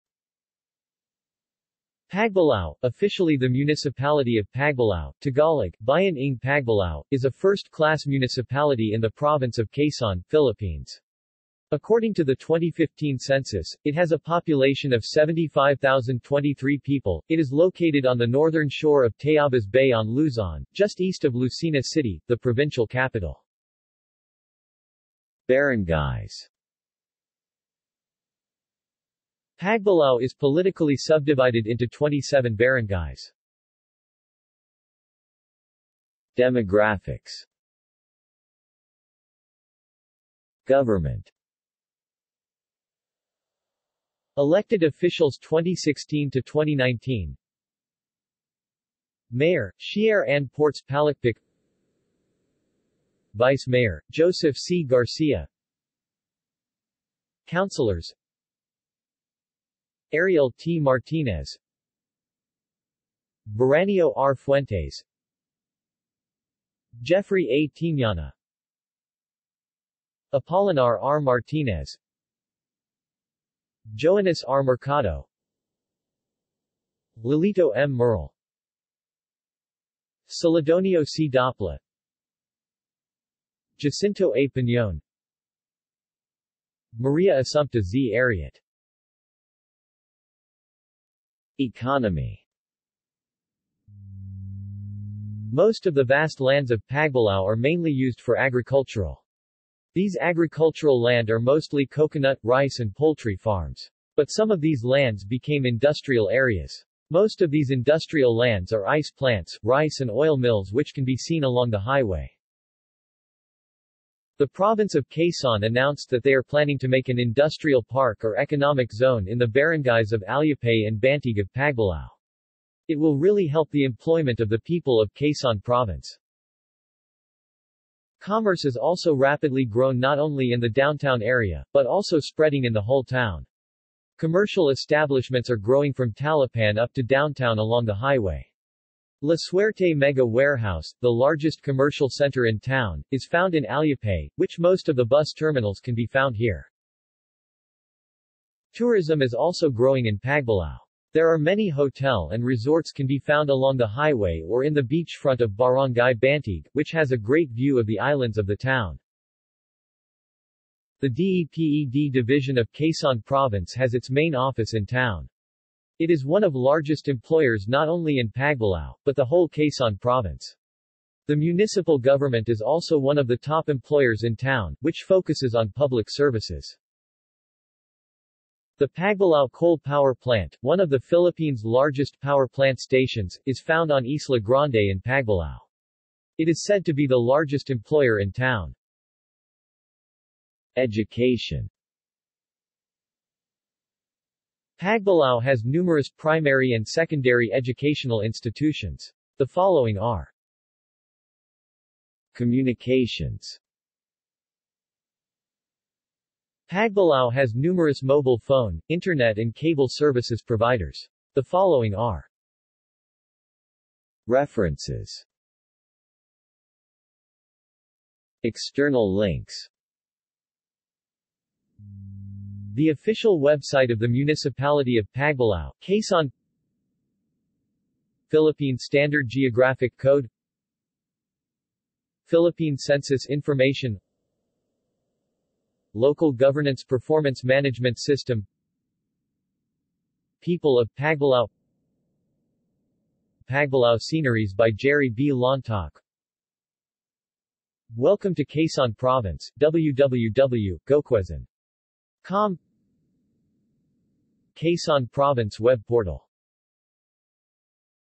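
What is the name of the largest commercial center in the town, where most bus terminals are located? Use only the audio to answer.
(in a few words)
La Suerte Mega Warehouse.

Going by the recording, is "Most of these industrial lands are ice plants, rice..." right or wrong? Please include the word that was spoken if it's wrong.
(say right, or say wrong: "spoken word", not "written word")
right.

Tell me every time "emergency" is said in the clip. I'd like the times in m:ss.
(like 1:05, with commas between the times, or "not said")
not said.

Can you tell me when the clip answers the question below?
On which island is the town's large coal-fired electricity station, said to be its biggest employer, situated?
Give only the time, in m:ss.
3:04.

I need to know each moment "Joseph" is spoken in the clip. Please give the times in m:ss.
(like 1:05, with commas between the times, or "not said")
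0:54.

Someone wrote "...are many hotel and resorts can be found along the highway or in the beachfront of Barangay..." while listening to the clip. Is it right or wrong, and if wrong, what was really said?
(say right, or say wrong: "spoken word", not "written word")
right.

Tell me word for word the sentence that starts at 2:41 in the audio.
The DEPED division of Quezon Province has its main office in town.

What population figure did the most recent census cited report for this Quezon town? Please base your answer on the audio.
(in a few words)
75,023.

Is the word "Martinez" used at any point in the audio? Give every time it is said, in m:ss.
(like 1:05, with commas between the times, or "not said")
1:00, 1:11.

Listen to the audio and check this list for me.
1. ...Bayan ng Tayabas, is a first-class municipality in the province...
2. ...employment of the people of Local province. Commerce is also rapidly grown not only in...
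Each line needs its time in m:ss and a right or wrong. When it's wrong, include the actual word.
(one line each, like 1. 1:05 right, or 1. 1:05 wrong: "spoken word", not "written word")
1. 0:05 wrong: "Pagbilao", not "Tayabas"
2. 2:03 wrong: "Quezon", not "Local".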